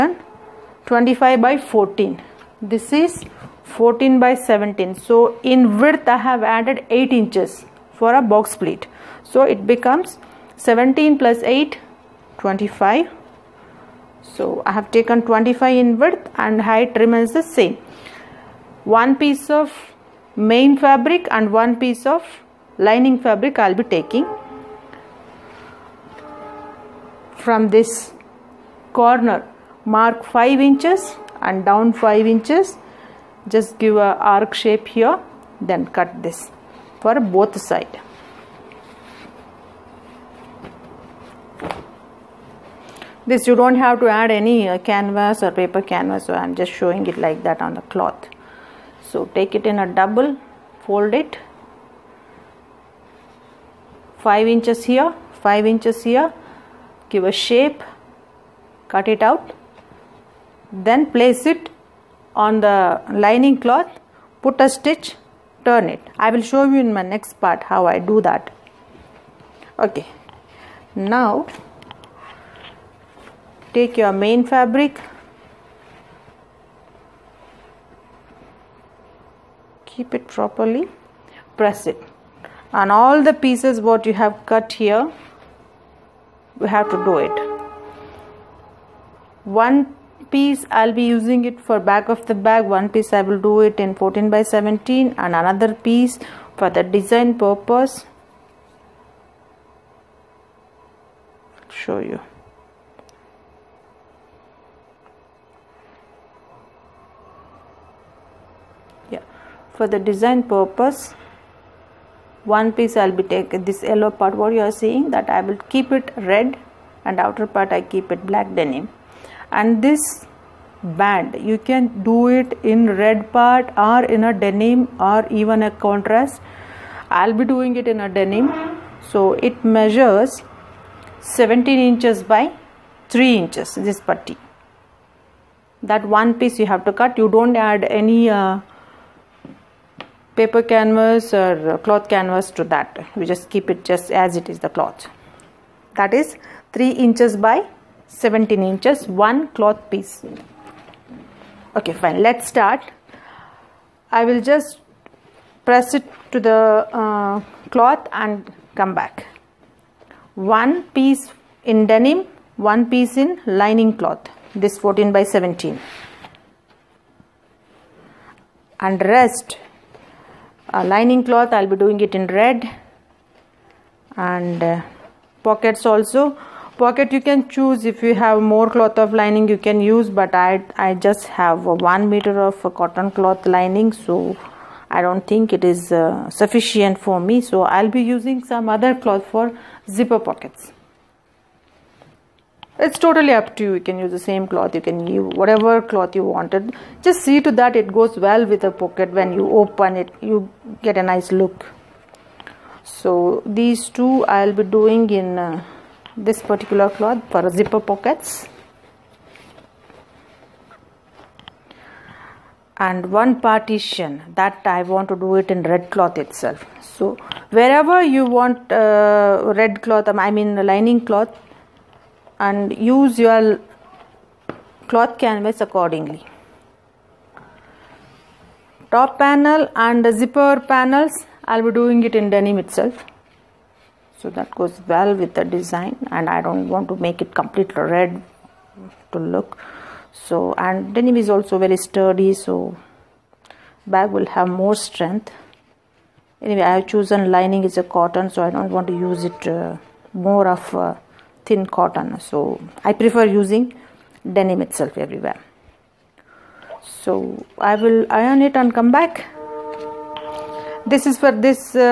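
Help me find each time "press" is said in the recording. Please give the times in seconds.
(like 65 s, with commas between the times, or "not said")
81 s, 155 s.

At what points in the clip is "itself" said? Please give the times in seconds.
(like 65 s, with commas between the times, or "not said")
216 s, 232 s, 254 s.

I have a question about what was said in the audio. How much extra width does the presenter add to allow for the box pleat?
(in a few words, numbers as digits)
8 inches.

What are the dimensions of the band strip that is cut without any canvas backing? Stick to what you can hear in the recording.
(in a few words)
3 by 17 inches.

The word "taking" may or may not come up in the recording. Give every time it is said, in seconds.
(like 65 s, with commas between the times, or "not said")
23 s, 113 s.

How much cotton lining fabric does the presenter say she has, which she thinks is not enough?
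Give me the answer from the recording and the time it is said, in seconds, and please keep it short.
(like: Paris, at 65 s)
1 meter, at 181 s.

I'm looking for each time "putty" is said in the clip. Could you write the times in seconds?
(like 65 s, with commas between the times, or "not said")
134 s.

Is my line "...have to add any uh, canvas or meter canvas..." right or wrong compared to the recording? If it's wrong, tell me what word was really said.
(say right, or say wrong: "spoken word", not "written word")
wrong: "paper", not "meter".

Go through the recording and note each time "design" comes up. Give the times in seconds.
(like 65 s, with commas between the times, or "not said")
96 s, 110 s, 235 s.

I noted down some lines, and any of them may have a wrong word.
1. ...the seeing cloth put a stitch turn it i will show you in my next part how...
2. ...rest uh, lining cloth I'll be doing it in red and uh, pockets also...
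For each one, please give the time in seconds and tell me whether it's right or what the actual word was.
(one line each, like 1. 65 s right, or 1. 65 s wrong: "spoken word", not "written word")
1. 62 s wrong: "lining", not "seeing"
2. 169 s right.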